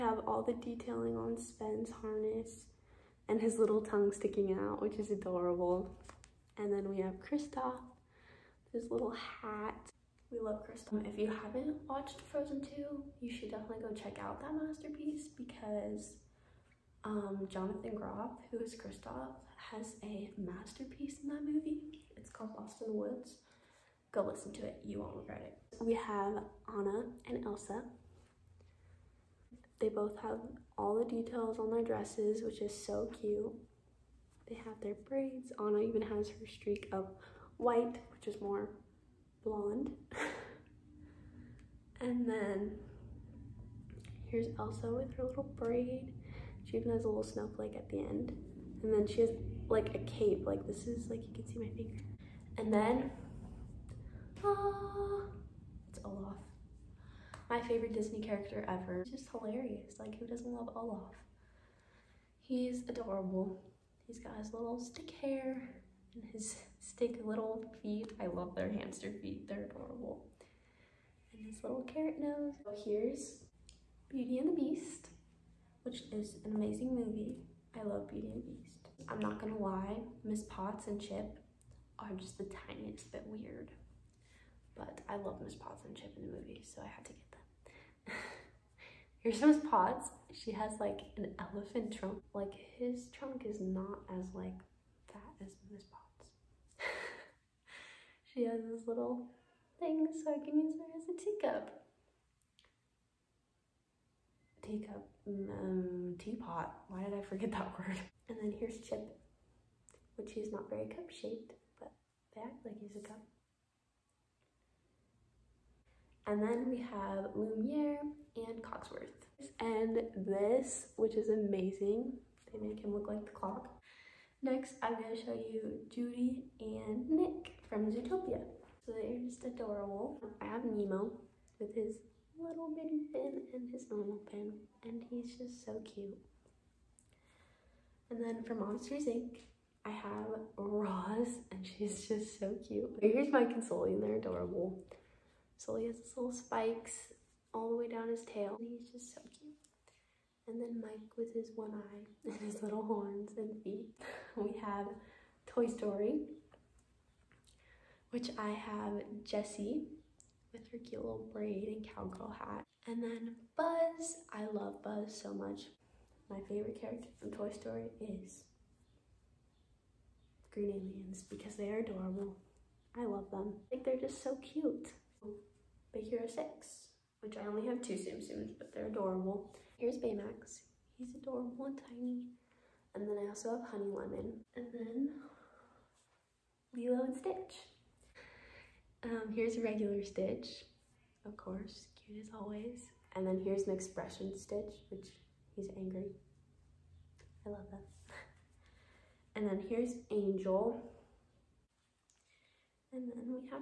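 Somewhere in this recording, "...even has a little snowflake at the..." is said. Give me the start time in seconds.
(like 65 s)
46 s.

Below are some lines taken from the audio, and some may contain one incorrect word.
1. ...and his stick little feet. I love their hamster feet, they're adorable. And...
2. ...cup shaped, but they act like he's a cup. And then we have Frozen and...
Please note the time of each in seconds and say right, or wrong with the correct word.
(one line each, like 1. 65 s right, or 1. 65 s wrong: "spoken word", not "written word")
1. 66 s right
2. 110 s wrong: "Lumiere", not "Frozen".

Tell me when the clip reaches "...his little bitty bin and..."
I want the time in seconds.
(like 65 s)
131 s.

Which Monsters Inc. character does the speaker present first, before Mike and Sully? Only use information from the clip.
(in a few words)
Roz.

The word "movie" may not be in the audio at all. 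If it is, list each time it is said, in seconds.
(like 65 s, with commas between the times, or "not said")
21 s, 76 s, 86 s.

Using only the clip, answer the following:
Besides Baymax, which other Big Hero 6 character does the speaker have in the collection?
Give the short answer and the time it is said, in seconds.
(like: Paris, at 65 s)
Honey Lemon, at 183 s.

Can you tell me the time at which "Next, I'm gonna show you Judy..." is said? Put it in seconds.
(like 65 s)
124 s.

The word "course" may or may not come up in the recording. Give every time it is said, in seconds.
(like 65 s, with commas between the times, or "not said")
191 s.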